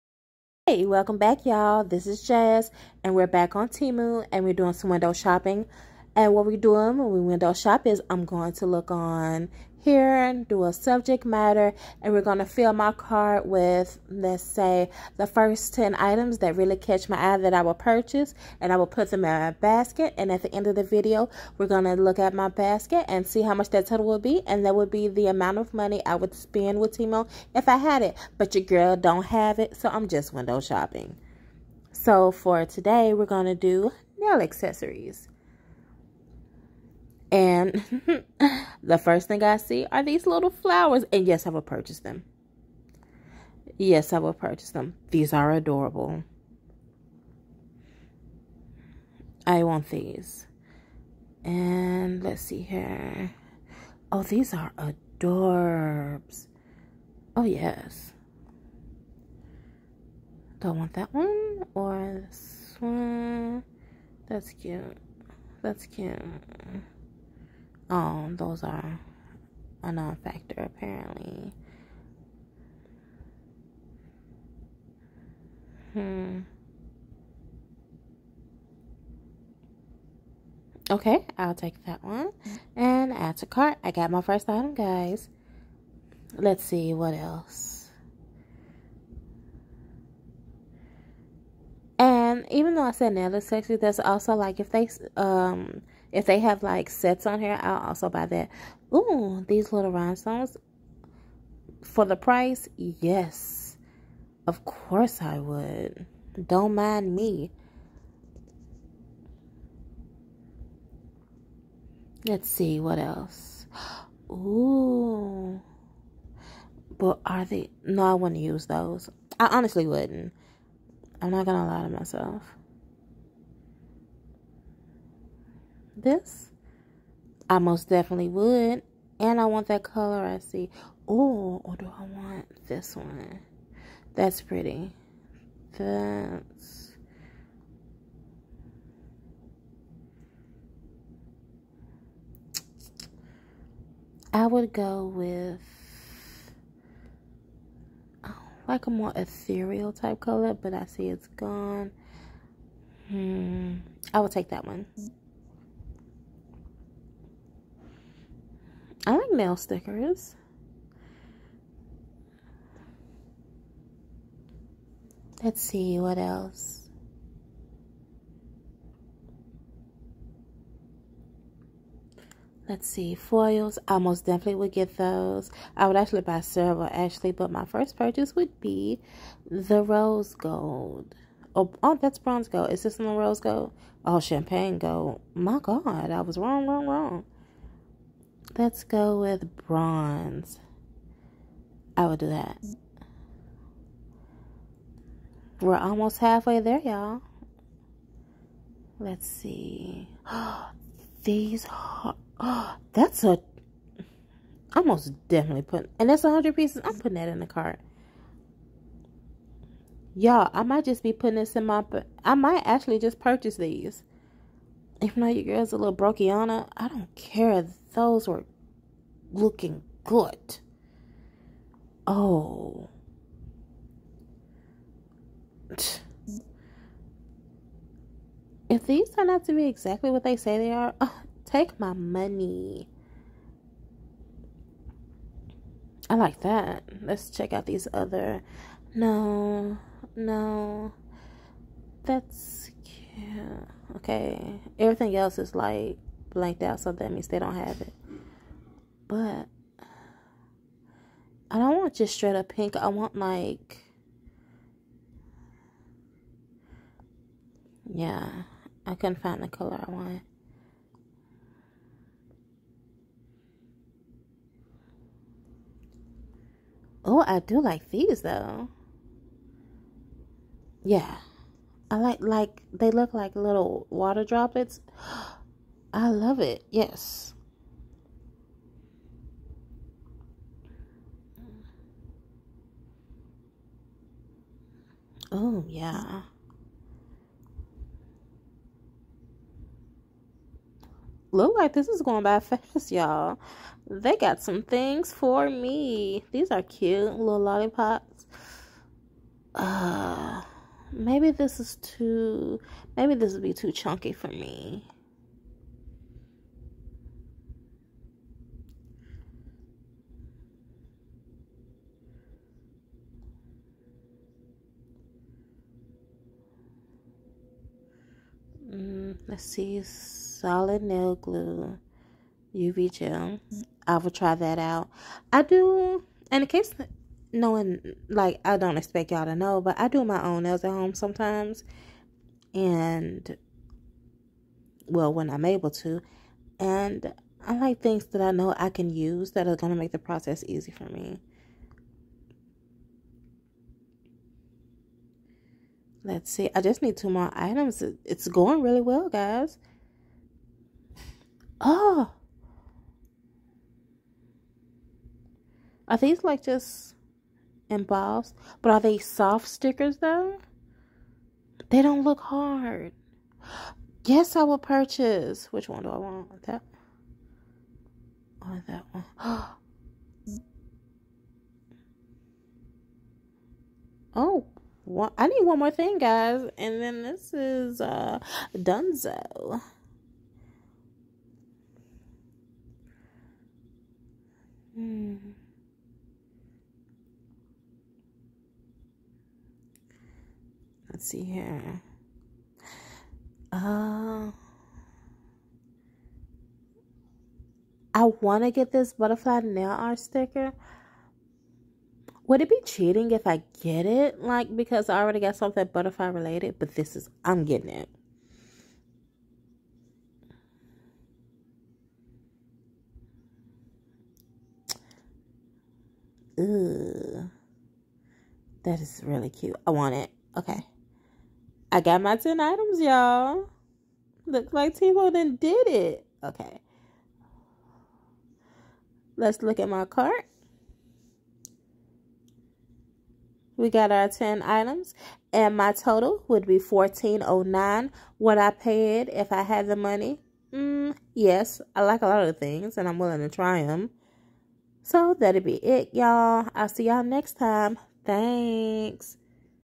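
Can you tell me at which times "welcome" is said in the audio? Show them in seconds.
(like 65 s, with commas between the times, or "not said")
0 s.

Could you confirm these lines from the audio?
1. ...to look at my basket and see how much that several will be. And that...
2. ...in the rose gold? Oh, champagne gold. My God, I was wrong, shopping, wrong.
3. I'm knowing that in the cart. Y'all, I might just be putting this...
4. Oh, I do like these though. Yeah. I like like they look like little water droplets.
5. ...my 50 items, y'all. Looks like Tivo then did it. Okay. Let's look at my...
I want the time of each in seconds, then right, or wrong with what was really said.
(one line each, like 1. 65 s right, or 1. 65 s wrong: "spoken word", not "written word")
1. 21 s wrong: "total", not "several"
2. 182 s wrong: "wrong", not "shopping"
3. 206 s wrong: "putting", not "knowing"
4. 267 s right
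5. 422 s wrong: "10", not "50".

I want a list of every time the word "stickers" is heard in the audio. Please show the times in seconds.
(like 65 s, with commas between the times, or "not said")
159 s, 359 s, 399 s.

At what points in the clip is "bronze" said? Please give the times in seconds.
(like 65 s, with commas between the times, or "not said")
182 s, 189 s.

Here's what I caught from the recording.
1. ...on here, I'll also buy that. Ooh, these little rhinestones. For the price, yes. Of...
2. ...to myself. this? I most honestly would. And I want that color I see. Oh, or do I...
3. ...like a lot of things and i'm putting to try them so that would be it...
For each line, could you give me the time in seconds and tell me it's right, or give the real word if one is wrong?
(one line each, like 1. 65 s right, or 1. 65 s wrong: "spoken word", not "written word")
1. 97 s right
2. 121 s wrong: "definitely", not "honestly"
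3. 441 s wrong: "willing", not "putting".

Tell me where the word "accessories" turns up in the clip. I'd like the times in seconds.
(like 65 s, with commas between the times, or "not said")
34 s, 93 s.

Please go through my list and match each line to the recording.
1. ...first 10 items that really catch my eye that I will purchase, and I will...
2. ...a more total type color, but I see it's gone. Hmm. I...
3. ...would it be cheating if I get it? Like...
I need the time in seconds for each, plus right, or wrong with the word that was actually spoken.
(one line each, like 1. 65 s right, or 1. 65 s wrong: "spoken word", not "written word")
1. 15 s right
2. 148 s wrong: "ethereal", not "total"
3. 402 s right.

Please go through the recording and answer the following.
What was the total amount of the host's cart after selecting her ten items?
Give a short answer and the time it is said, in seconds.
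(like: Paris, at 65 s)
1409, at 436 s.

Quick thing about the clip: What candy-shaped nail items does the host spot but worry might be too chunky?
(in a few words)
Lollipops.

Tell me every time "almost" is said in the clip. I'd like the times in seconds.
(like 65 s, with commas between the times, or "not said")
195 s, 204 s.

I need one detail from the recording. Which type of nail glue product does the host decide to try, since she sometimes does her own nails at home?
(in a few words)
Solid nail glue.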